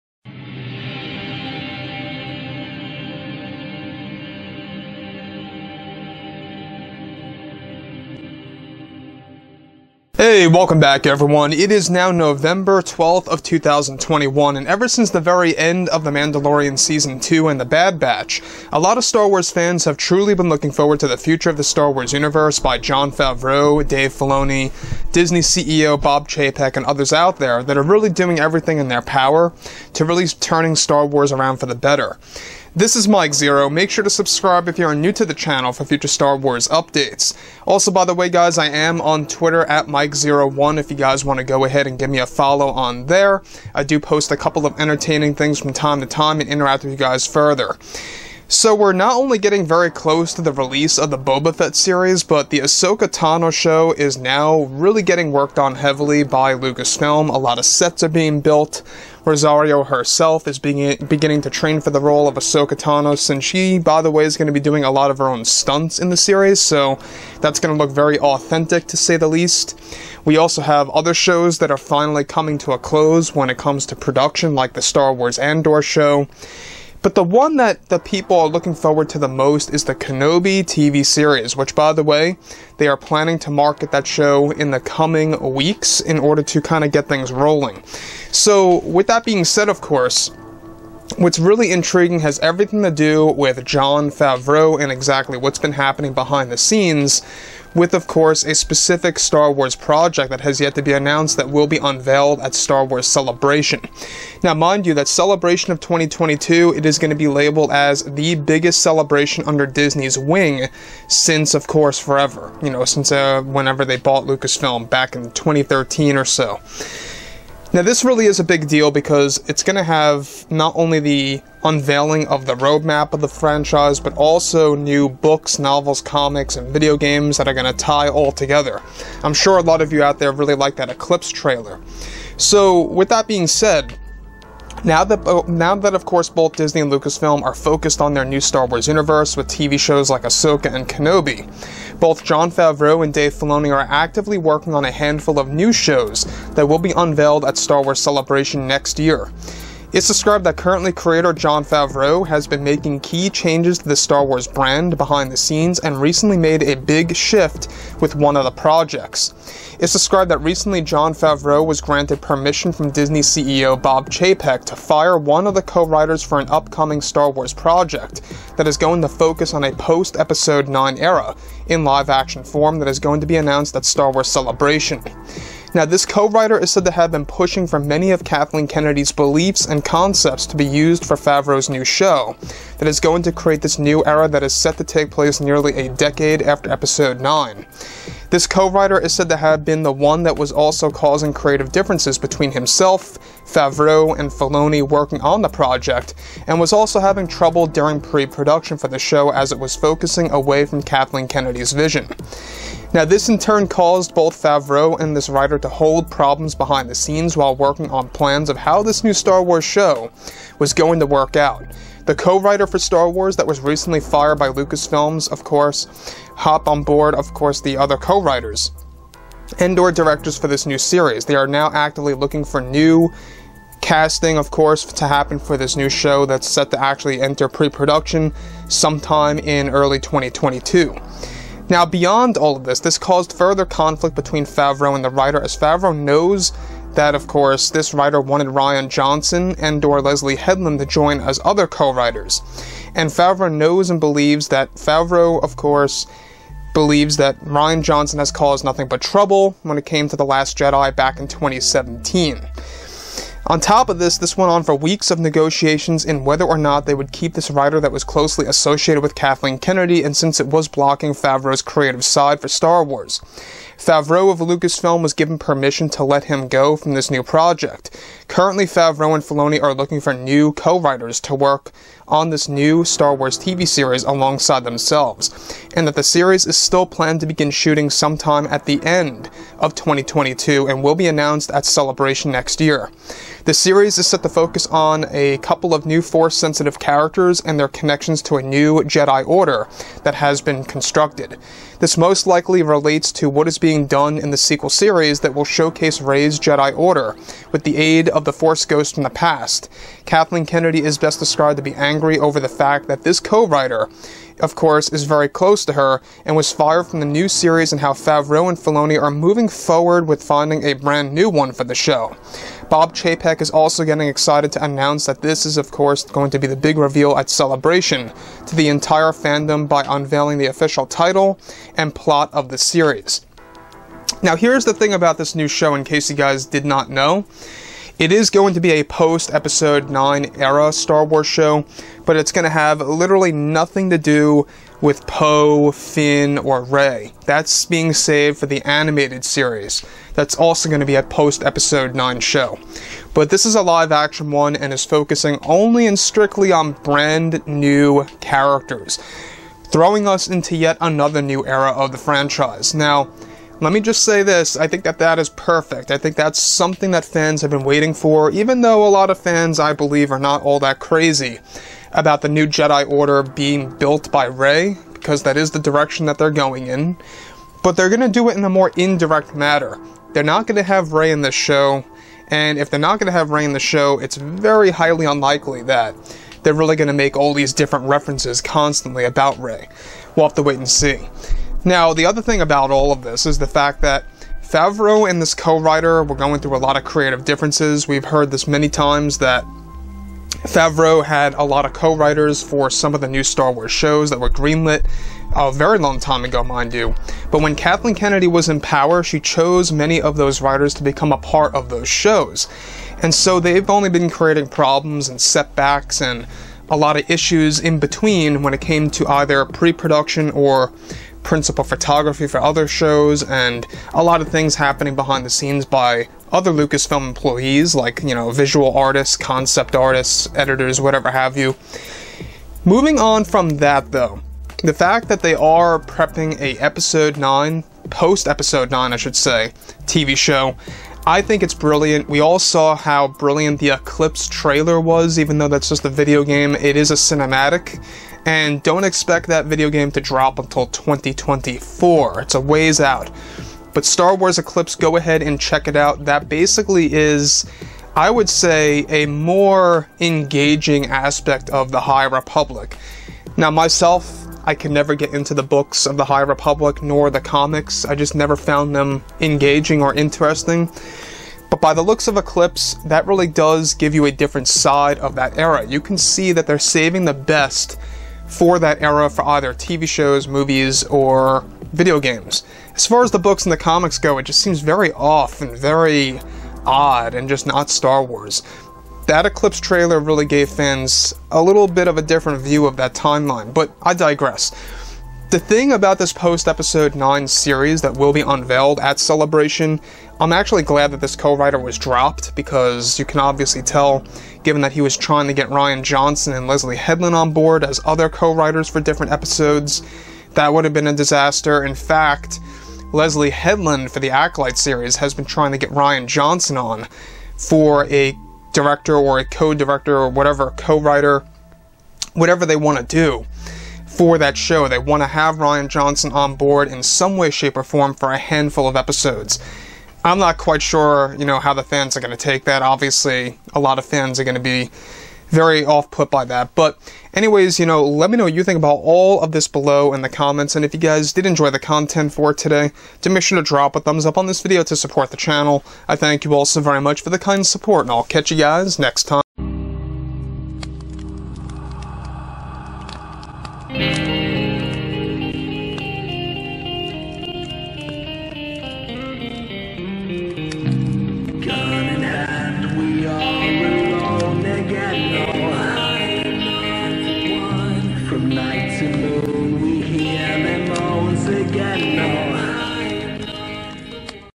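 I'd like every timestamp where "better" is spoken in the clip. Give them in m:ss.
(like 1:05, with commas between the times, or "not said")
0:31.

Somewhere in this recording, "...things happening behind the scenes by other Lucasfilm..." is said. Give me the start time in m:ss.
6:54.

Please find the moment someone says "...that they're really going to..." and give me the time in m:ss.
6:15.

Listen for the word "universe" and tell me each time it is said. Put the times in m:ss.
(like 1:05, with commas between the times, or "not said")
0:22, 2:18.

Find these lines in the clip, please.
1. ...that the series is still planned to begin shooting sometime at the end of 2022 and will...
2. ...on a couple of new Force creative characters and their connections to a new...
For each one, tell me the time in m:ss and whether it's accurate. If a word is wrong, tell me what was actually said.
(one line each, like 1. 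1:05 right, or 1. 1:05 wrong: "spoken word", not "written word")
1. 4:35 right
2. 4:44 wrong: "sensitive", not "creative".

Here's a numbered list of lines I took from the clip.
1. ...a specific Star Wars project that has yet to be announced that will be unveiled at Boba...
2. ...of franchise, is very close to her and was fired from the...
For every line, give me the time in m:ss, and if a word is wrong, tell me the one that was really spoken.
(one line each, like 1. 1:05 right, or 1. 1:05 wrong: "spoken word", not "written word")
1. 1:38 wrong: "Star", not "Boba"
2. 5:04 wrong: "course", not "franchise".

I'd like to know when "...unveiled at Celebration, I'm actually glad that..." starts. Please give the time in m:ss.
8:08.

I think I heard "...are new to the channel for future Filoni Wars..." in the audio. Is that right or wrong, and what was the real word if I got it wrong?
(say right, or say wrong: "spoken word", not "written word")
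wrong: "Star", not "Filoni".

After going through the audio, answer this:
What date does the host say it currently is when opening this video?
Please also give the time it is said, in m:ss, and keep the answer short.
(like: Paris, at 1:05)
November 12th, 2021, at 0:12.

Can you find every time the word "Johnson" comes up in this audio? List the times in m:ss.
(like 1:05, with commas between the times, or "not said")
3:58, 4:07, 8:15, 8:26, 8:35.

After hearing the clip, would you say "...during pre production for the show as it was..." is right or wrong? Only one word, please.
right.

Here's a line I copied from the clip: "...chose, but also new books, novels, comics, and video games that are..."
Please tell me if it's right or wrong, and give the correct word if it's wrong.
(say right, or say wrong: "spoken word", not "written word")
wrong: "franchise", not "chose".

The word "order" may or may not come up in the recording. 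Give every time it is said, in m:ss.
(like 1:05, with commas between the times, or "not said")
1:26, 4:49, 4:56, 6:02.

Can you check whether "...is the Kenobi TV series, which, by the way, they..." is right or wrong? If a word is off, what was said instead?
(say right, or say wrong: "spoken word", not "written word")
right.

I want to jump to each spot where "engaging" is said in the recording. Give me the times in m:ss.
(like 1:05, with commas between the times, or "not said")
7:29, 7:39.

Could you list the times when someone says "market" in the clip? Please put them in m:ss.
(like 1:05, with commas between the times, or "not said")
1:23.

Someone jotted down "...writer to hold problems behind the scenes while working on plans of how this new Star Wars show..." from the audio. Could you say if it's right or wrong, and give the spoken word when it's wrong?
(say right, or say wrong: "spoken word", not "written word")
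right.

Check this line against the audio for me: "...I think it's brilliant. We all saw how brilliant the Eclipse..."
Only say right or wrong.
right.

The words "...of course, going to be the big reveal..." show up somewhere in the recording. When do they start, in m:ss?
5:15.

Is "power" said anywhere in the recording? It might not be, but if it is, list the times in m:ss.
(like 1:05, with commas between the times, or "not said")
0:29, 6:38.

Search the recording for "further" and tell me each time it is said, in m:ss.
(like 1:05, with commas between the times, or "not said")
0:47, 3:53.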